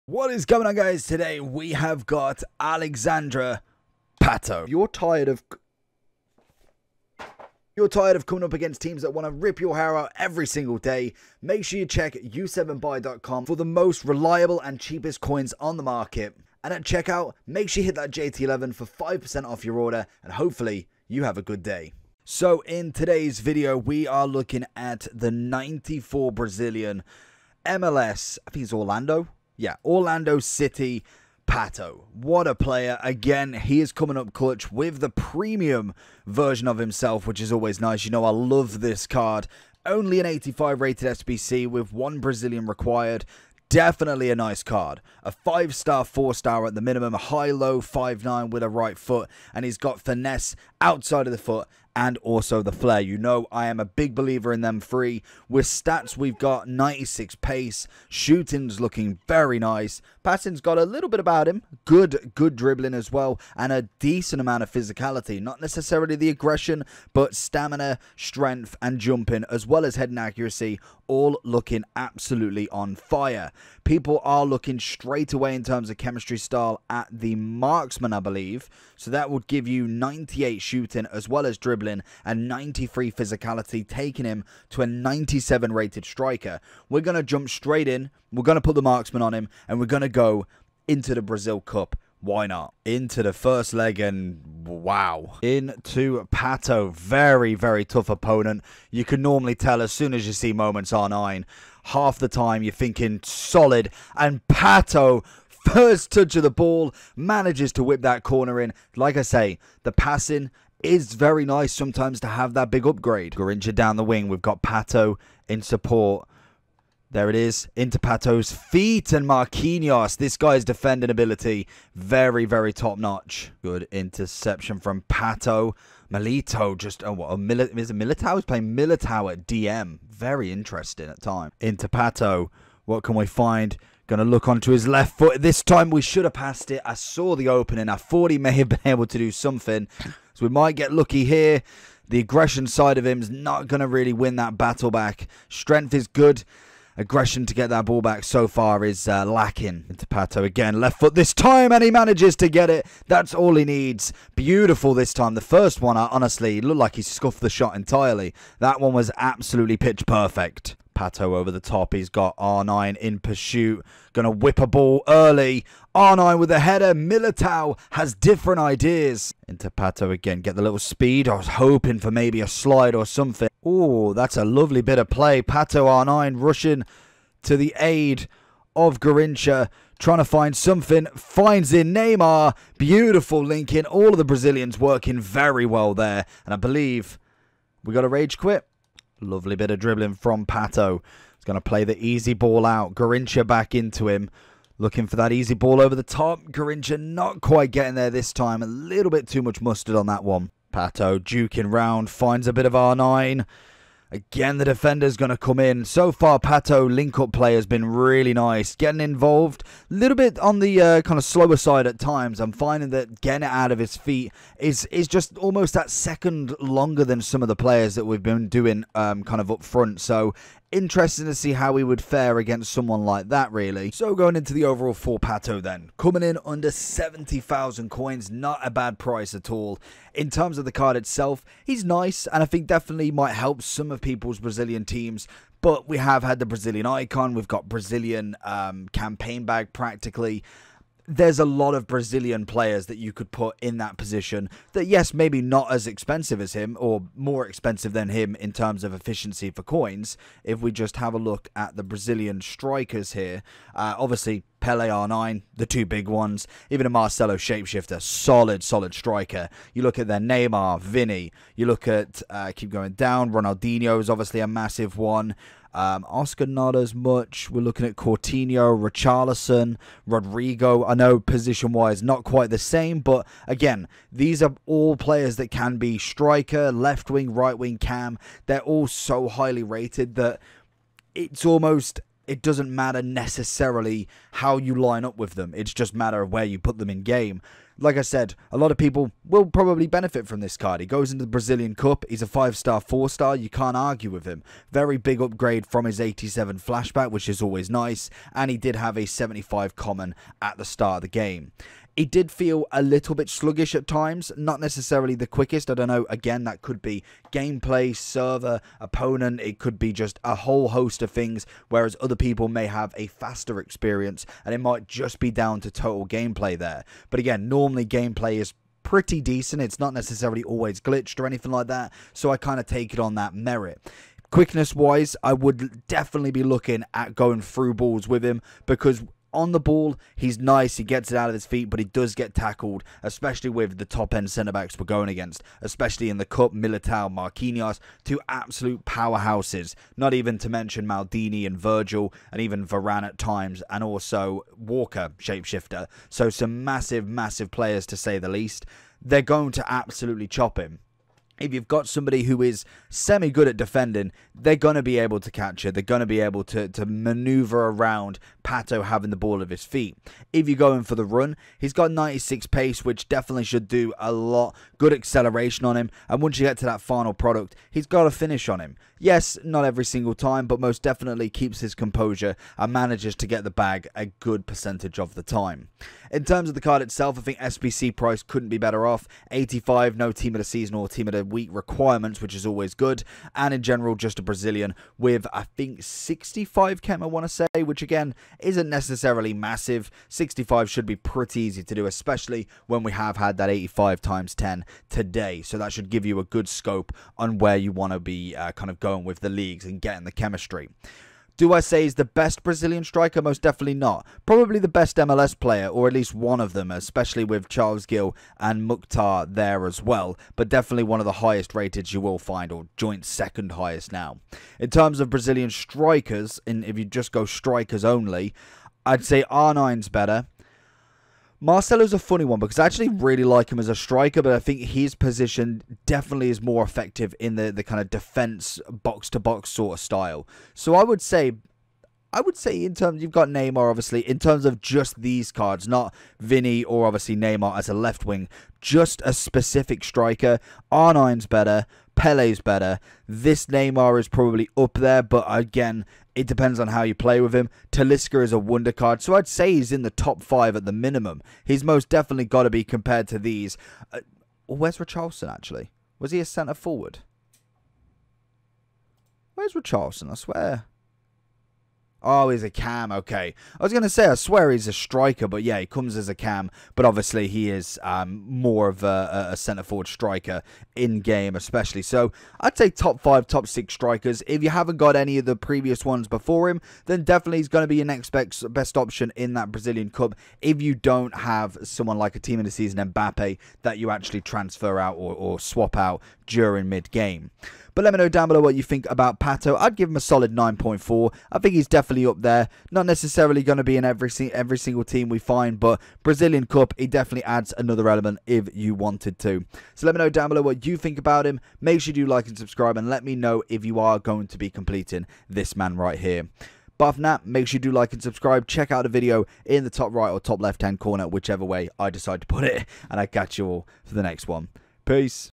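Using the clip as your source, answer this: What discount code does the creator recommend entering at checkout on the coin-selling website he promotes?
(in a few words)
JT11.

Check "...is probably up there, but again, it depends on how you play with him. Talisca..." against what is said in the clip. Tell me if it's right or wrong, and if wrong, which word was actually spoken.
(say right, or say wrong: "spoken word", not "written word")
right.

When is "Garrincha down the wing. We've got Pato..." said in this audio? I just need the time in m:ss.
1:53.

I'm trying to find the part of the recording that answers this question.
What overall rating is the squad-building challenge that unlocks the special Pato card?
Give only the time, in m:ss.
0:40.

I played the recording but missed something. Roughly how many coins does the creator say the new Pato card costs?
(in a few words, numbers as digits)
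under 70,000.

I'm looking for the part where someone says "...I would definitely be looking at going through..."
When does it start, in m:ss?
5:25.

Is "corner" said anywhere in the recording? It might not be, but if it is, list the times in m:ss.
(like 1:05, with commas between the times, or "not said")
1:48, 8:30.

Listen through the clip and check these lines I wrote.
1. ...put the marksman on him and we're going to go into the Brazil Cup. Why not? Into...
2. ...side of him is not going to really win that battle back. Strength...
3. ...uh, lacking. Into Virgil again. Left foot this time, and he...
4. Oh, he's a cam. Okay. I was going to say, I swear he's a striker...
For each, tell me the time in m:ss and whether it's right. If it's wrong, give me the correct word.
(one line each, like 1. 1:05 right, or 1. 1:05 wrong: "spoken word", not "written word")
1. 1:28 right
2. 2:22 right
3. 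2:29 wrong: "Pato", not "Virgil"
4. 7:42 right.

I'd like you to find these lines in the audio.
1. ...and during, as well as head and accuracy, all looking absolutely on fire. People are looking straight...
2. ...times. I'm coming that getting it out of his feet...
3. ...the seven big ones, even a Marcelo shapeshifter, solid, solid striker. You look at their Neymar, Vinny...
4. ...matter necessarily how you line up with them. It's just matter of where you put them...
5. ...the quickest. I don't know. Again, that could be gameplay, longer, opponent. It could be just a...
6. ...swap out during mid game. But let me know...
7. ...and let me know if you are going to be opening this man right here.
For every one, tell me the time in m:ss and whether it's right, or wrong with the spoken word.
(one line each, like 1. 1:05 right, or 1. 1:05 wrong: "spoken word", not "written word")
1. 1:08 wrong: "jumping", not "during"
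2. 3:31 wrong: "finding", not "coming"
3. 4:15 wrong: "two", not "seven"
4. 4:42 right
5. 5:05 wrong: "server", not "longer"
6. 8:05 right
7. 8:22 wrong: "completing", not "opening".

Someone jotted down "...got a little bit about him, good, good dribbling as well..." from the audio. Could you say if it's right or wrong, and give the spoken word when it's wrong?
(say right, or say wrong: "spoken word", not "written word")
right.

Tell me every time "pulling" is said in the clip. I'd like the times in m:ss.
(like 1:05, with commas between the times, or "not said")
not said.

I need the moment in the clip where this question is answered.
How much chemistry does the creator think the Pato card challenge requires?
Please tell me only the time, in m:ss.
6:25.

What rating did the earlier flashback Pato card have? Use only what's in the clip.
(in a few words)
87.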